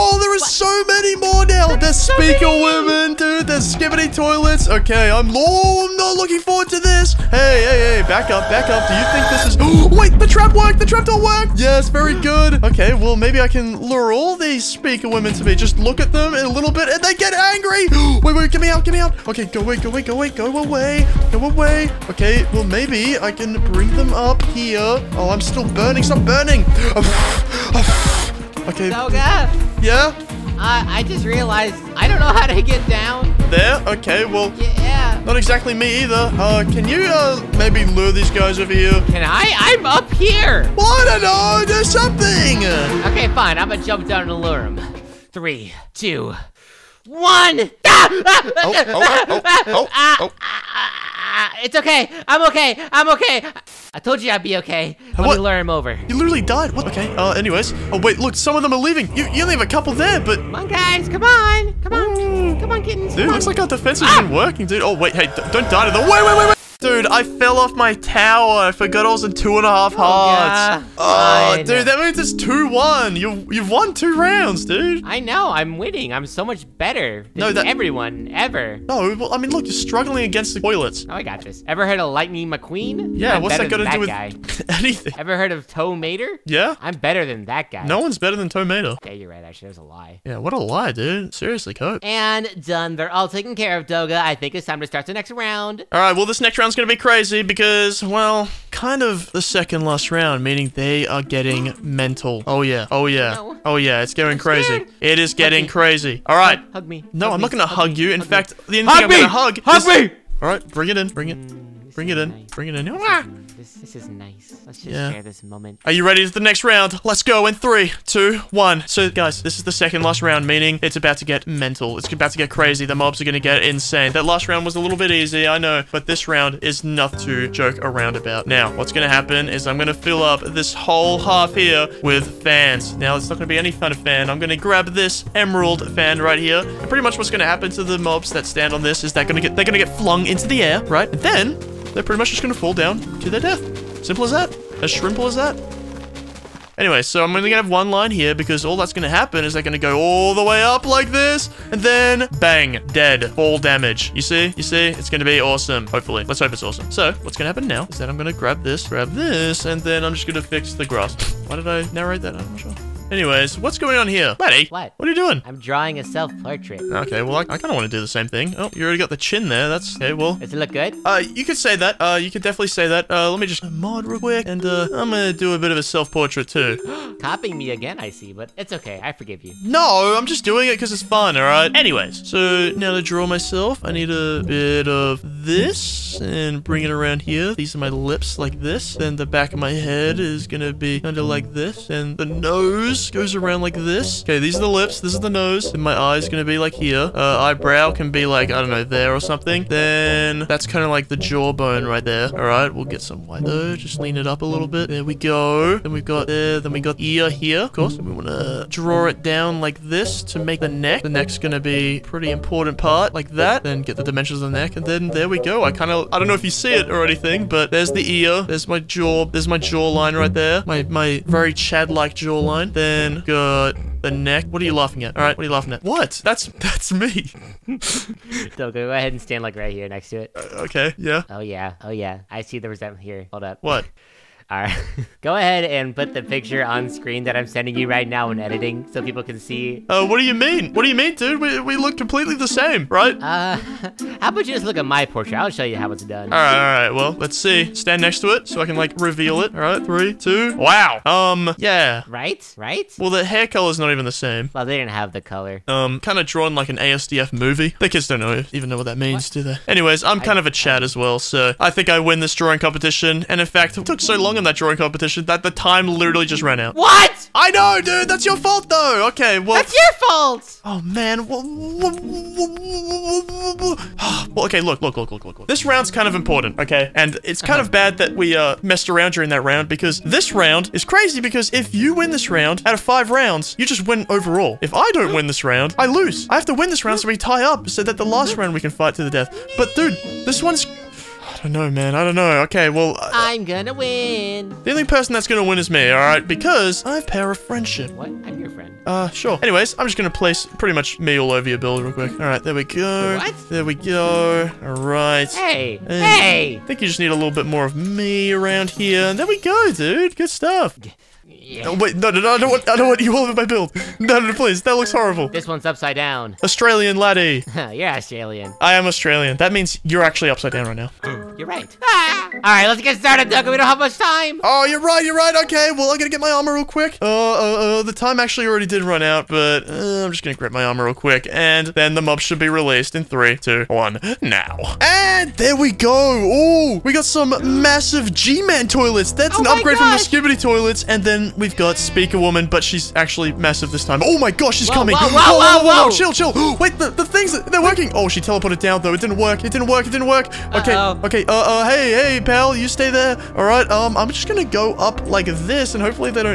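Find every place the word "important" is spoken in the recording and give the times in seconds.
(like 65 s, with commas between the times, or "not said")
212 s, 276 s.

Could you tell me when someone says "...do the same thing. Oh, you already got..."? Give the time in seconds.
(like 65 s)
167 s.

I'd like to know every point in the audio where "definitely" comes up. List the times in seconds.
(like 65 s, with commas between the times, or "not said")
172 s.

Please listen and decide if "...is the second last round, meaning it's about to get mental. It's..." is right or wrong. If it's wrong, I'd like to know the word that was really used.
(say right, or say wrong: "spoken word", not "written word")
right.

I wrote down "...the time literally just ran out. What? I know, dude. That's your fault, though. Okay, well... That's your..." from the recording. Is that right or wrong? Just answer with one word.
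right.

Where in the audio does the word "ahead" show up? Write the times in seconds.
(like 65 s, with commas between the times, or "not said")
228 s, 235 s.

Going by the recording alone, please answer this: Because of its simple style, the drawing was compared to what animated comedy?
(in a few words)
ASDF movie.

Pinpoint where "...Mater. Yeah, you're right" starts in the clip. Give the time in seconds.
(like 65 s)
88 s.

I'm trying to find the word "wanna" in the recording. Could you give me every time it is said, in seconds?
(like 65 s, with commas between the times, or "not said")
208 s.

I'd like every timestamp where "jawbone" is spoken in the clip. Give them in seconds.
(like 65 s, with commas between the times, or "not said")
201 s.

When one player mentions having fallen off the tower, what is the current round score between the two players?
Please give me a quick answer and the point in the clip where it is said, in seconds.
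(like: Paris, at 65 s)
2-1, at 72 s.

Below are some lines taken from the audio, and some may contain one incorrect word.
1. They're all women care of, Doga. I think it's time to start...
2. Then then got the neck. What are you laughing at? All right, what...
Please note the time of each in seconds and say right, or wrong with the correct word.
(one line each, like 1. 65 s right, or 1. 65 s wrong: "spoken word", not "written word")
1. 92 s wrong: "taken", not "women"
2. 222 s right.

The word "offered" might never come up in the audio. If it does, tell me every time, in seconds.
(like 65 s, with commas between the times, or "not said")
not said.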